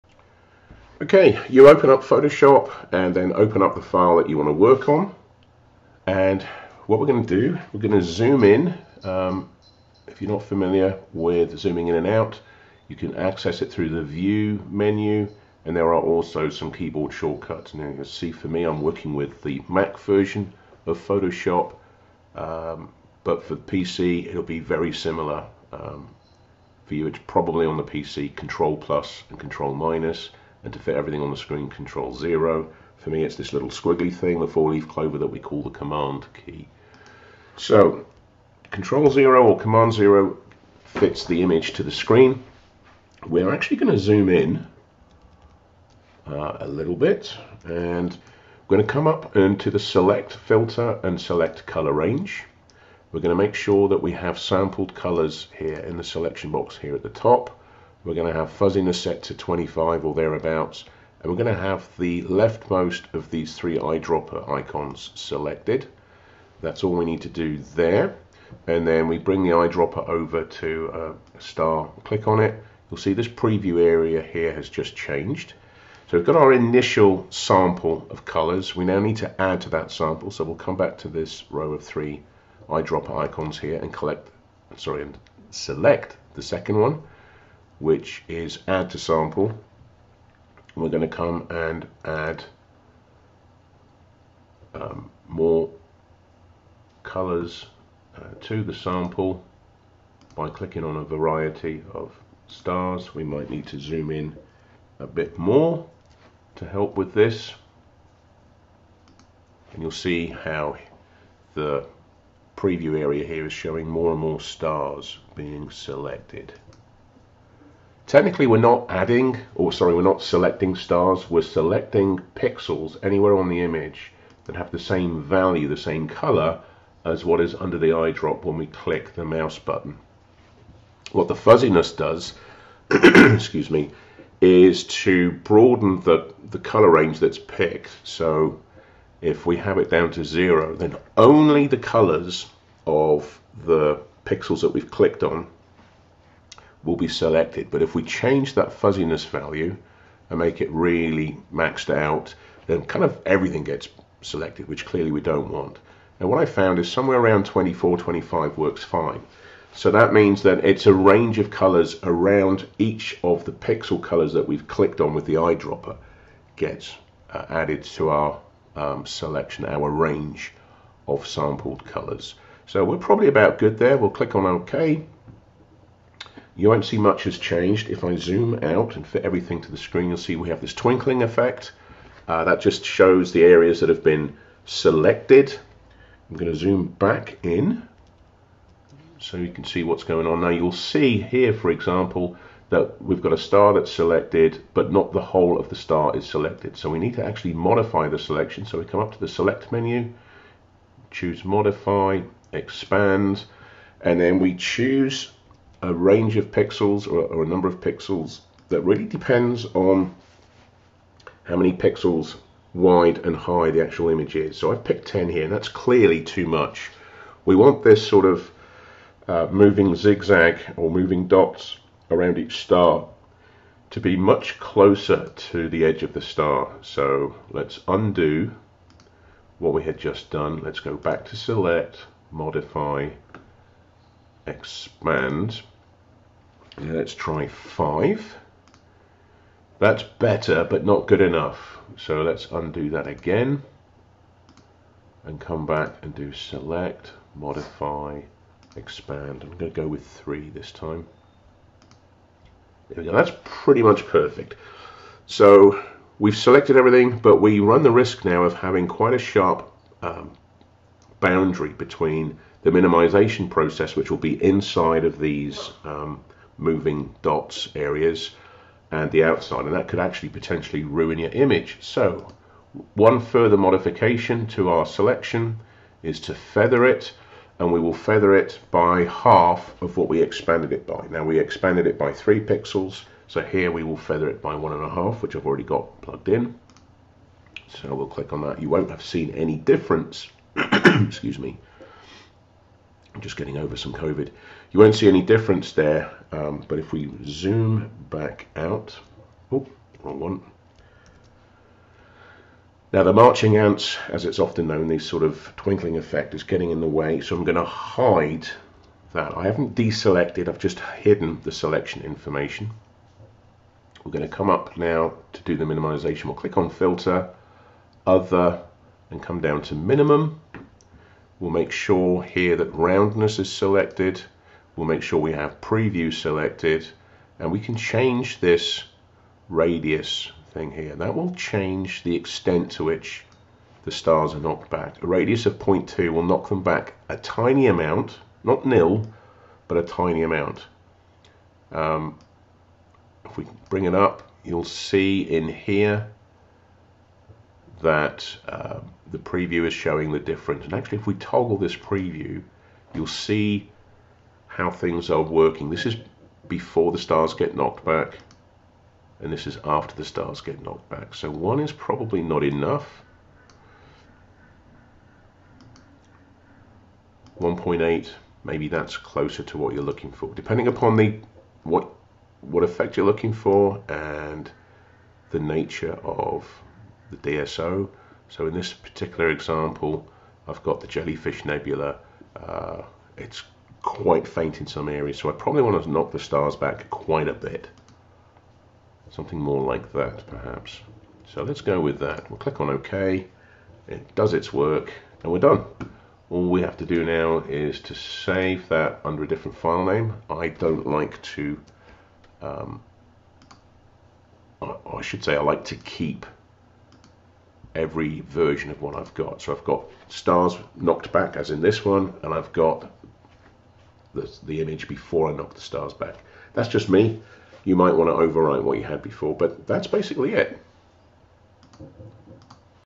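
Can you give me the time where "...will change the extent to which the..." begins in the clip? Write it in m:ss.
5:31.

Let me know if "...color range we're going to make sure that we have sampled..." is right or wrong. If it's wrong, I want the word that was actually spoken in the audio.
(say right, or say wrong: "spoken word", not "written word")
right.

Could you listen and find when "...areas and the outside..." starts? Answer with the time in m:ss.
4:27.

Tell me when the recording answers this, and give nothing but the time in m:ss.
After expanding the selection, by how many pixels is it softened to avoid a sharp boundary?
4:44.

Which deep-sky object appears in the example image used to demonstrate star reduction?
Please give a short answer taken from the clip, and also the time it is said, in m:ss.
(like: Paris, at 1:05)
Jellyfish Nebula, at 6:20.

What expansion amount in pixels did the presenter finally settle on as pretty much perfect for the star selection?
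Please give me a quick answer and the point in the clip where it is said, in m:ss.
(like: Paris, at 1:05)
3, at 4:09.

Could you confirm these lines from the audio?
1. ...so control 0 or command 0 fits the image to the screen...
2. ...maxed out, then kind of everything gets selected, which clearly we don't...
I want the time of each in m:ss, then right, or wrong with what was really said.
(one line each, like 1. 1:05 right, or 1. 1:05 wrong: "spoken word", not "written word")
1. 0:37 right
2. 2:31 right.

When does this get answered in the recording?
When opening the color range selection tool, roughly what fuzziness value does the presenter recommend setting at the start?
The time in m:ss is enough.
0:58.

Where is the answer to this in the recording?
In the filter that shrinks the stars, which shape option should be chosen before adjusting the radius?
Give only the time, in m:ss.
5:22.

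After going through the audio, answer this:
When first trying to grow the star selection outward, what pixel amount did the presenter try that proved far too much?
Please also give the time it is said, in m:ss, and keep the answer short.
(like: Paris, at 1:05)
10, at 3:34.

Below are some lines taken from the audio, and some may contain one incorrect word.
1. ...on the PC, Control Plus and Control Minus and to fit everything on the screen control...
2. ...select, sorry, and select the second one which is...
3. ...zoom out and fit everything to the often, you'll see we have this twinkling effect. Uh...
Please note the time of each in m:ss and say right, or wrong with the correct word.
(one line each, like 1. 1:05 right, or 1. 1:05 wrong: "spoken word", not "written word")
1. 0:27 right
2. 1:23 wrong: "collect", not "select"
3. 2:58 wrong: "screen", not "often".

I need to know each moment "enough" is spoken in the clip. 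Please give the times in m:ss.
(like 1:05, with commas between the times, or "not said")
4:01, 6:02.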